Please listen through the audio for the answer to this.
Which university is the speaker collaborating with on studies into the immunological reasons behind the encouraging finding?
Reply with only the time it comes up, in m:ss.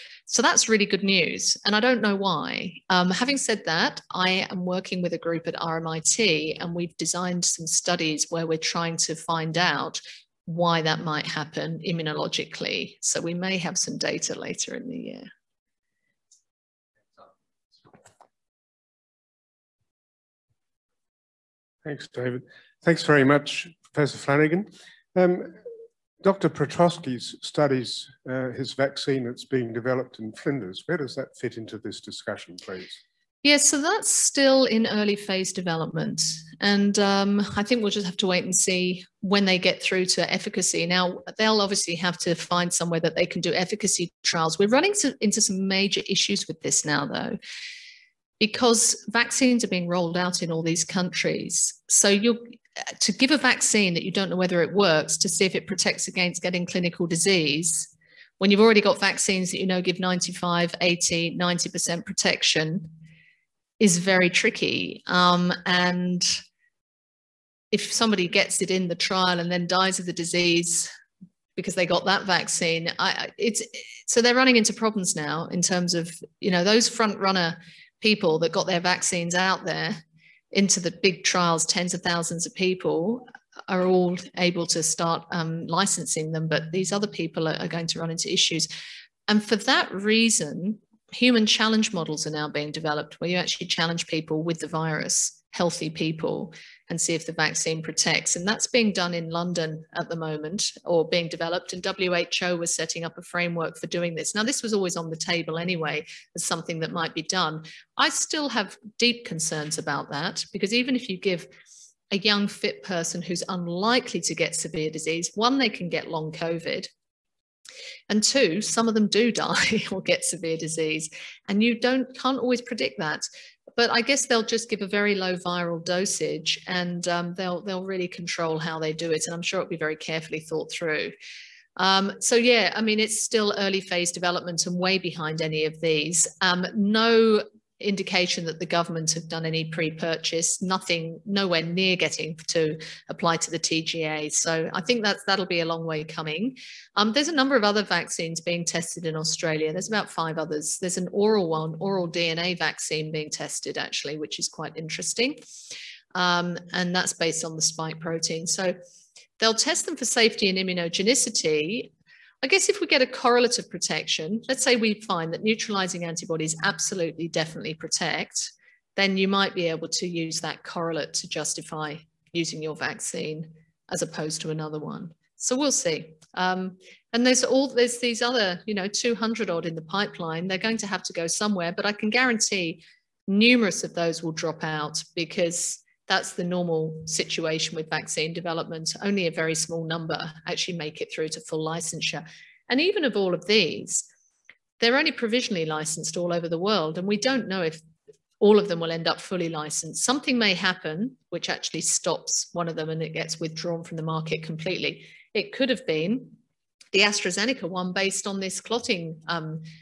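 0:05.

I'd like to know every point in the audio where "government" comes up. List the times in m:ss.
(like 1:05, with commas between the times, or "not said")
2:18.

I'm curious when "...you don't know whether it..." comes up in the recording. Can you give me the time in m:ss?
0:54.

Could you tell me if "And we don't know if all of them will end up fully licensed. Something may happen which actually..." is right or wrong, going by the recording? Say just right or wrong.
right.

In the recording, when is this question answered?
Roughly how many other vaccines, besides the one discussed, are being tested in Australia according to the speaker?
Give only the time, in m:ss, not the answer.
2:29.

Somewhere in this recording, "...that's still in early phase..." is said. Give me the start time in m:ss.
0:33.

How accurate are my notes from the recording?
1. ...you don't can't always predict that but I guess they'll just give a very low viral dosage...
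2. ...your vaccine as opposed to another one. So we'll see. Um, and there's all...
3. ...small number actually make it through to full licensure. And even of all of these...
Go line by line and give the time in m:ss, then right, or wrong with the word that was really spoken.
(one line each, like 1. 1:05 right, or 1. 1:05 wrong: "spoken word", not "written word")
1. 2:01 right
2. 2:52 right
3. 3:09 right.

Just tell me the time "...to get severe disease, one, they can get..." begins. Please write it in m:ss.
1:54.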